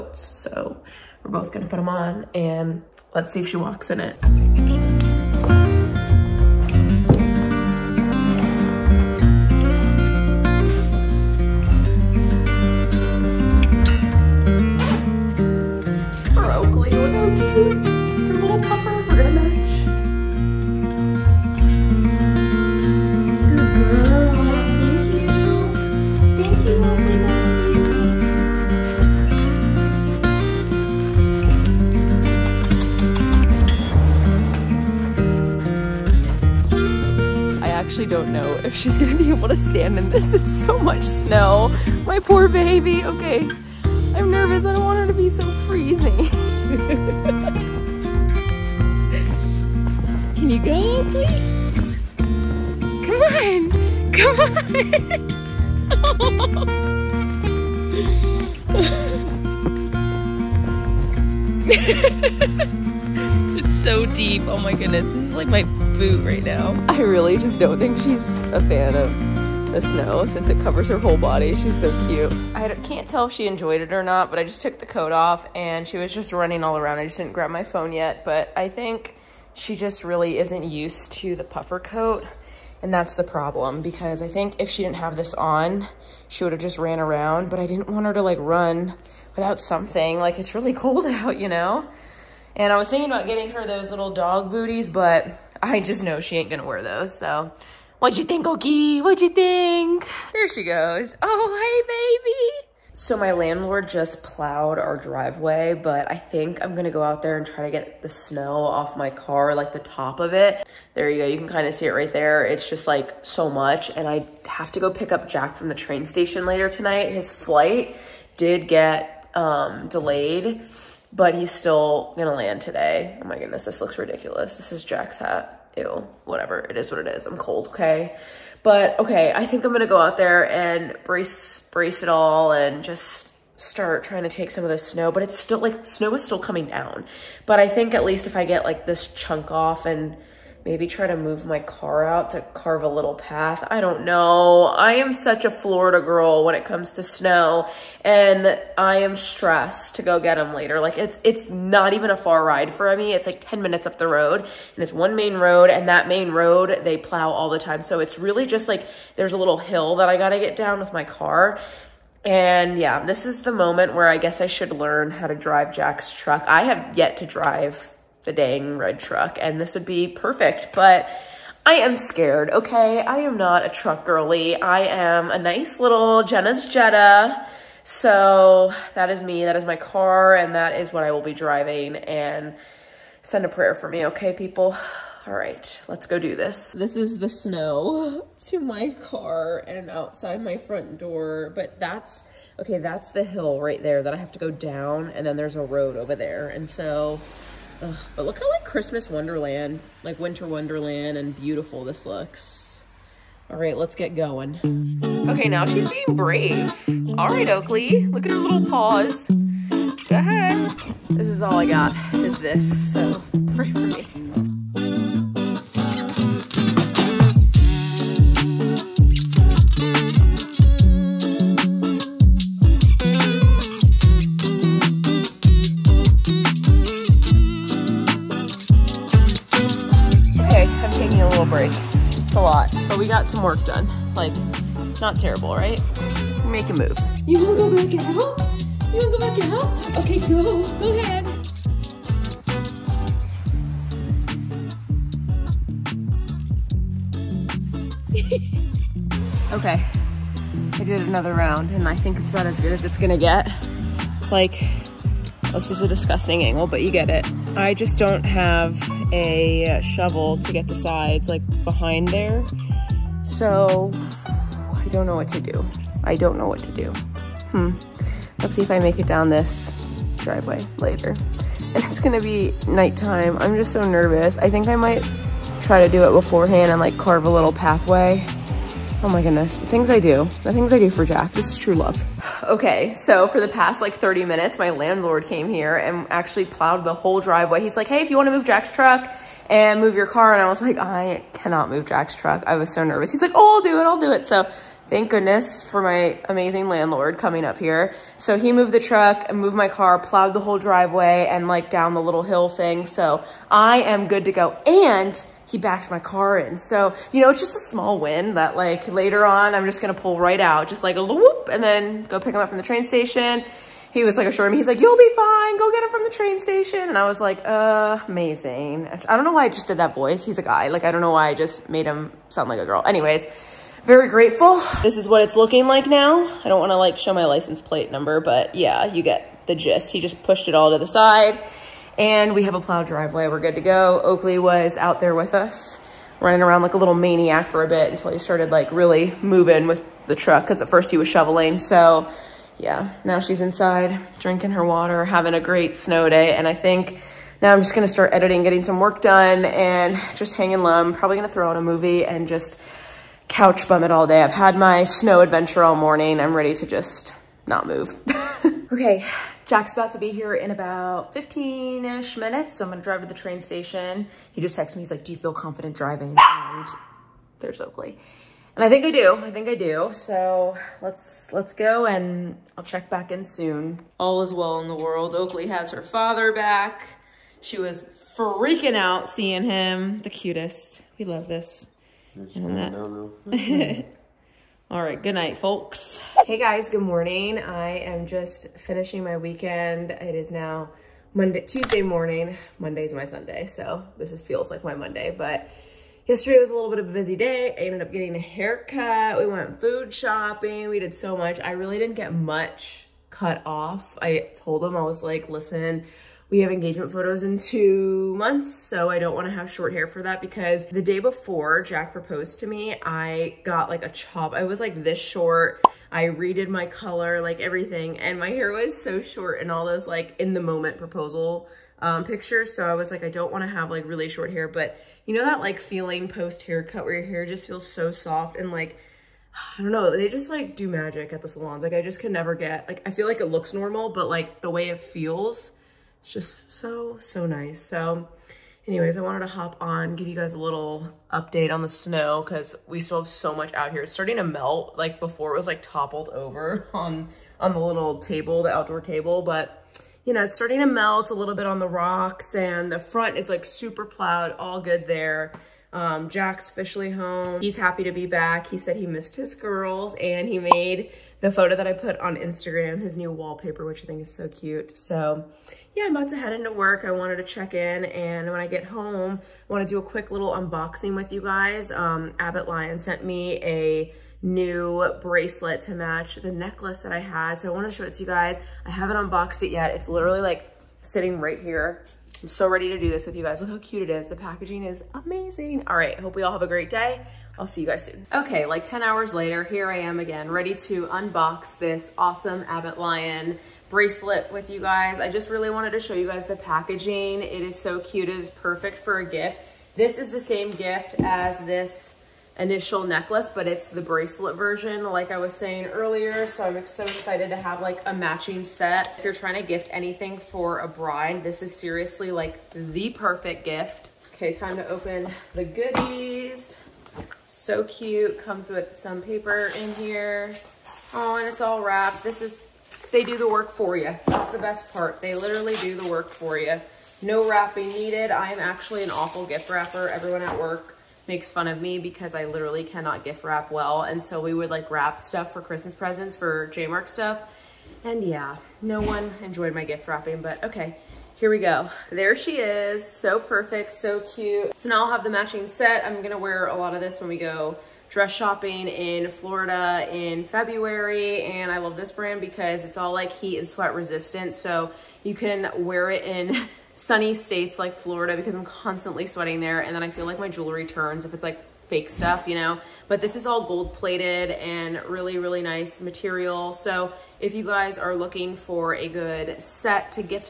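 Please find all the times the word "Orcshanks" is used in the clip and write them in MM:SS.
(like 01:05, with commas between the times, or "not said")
not said.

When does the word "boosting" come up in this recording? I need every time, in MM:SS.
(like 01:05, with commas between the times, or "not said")
not said.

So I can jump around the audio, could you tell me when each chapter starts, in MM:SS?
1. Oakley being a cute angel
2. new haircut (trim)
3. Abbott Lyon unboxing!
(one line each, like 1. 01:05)
1. 00:30
2. 06:26
3. 07:48.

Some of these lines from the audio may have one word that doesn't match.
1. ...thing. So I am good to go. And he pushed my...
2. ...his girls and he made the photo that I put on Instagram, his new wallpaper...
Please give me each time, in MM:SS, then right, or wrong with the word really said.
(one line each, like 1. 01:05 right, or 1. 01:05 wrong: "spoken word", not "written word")
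1. 05:02 wrong: "backed", not "pushed"
2. 07:39 right.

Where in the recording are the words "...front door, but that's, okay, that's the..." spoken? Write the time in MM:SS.
03:10.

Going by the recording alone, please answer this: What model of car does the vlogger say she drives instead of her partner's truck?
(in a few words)
Jetta.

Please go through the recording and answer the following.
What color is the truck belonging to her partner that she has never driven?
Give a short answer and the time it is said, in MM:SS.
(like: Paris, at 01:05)
red, at 02:48.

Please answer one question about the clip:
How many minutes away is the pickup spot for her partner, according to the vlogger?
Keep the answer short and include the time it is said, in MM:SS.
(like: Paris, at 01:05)
10, at 02:33.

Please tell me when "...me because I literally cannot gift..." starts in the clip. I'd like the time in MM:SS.
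08:51.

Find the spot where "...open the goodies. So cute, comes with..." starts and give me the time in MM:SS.
08:34.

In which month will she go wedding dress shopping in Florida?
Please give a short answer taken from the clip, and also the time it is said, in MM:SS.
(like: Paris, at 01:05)
February, at 09:10.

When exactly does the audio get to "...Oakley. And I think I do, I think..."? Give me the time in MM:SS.
06:07.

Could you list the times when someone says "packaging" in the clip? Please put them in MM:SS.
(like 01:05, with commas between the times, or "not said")
08:04, 08:16.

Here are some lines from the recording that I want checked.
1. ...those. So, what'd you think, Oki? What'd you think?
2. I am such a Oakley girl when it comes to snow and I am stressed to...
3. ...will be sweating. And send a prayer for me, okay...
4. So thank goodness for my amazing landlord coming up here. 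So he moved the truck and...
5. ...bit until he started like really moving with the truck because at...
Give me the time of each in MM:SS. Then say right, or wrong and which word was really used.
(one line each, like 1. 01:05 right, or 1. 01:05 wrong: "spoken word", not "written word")
1. 01:36 right
2. 02:24 wrong: "Florida", not "Oakley"
3. 03:01 wrong: "driving", not "sweating"
4. 04:54 right
5. 05:37 right.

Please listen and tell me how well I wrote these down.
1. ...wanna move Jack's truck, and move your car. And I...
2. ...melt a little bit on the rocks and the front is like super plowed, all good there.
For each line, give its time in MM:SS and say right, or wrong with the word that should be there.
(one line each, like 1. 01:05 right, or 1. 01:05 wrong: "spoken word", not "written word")
1. 04:48 right
2. 07:30 right.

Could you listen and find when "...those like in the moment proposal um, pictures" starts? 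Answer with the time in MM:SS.
06:59.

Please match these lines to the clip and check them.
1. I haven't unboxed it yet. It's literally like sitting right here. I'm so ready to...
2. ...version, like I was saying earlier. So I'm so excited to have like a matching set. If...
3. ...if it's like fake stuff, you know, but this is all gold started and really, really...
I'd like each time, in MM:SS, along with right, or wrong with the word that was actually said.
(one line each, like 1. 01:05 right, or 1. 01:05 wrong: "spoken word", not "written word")
1. 07:58 right
2. 08:24 right
3. 09:21 wrong: "plated", not "started".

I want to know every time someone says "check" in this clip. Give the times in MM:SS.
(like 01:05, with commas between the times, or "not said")
06:12, 07:47.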